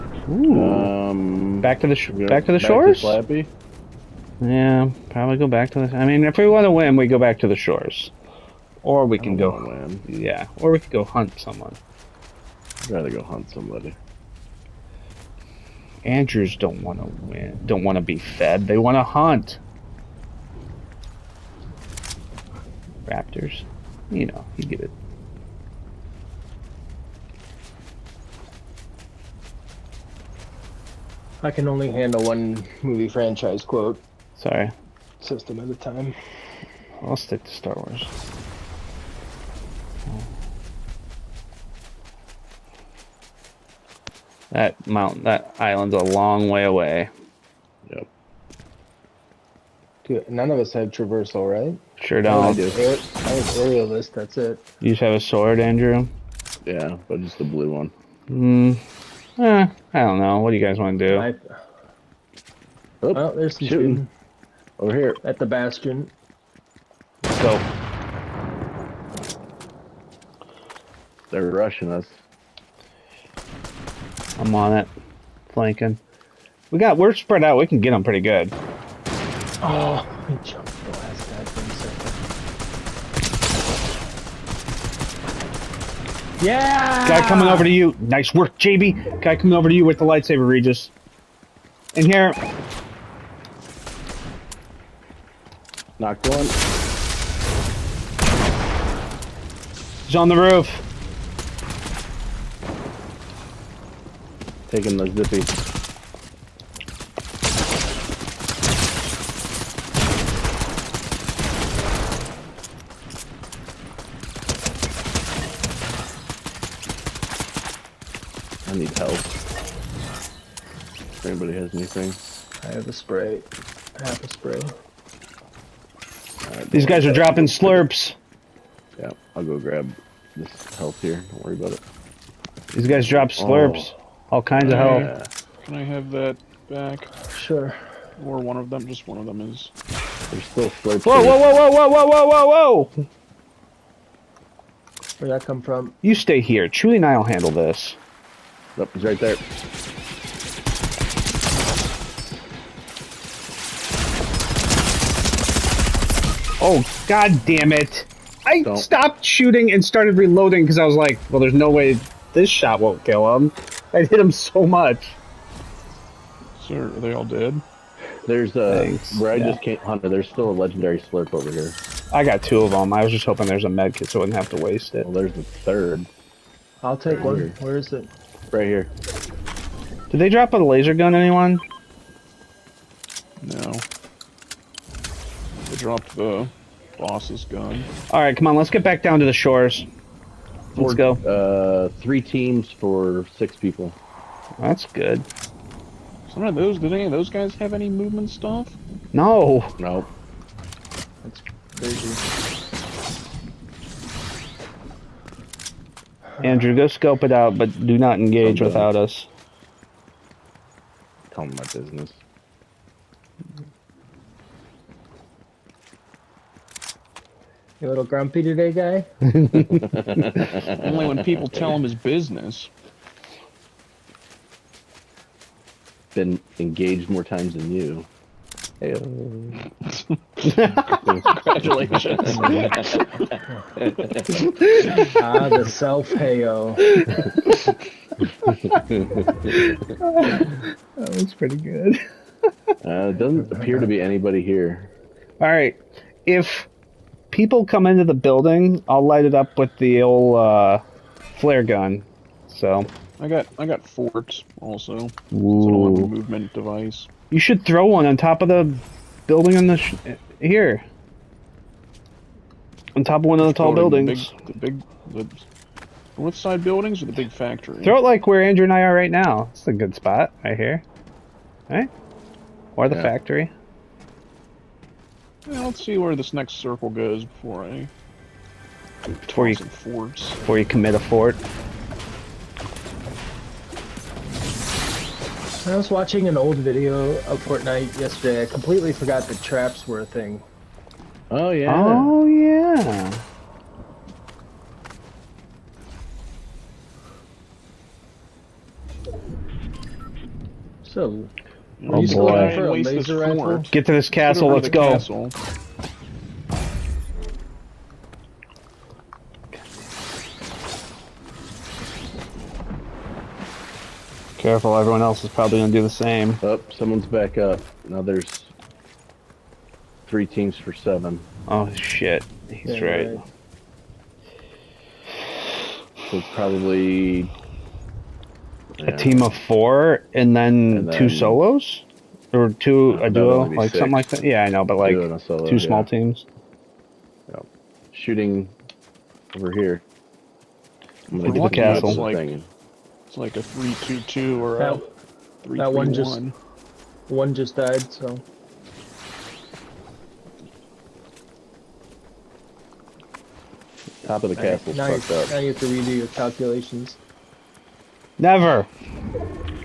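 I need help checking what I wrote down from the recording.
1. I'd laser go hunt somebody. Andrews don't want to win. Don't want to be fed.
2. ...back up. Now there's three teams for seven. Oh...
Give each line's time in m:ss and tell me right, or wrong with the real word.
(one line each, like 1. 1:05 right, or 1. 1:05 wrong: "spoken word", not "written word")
1. 0:12 wrong: "rather", not "laser"
2. 5:17 right.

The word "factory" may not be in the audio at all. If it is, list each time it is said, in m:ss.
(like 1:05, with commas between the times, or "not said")
4:27, 4:33.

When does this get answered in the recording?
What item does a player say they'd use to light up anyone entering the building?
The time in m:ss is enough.
4:11.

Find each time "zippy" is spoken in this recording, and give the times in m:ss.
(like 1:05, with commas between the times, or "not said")
1:45.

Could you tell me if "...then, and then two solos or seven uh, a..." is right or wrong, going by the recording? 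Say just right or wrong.
wrong.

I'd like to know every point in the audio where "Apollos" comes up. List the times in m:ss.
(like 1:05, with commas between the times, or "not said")
not said.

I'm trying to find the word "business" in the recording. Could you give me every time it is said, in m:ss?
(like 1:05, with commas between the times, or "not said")
3:31, 3:41.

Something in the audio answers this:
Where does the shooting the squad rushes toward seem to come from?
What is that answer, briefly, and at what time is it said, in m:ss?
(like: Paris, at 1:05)
The bastion, at 1:05.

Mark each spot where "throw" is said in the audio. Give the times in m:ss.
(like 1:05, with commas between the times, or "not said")
4:17, 4:27.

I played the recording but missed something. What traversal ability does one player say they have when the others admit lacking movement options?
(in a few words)
Aerialist.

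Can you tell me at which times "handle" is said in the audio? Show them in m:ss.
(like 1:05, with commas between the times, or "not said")
0:31, 2:27.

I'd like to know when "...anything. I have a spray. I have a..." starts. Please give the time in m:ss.
2:01.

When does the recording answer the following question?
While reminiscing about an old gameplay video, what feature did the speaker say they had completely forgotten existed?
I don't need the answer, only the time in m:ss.
4:49.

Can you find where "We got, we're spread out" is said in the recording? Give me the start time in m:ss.
1:16.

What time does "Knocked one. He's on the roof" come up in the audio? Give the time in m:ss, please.
1:35.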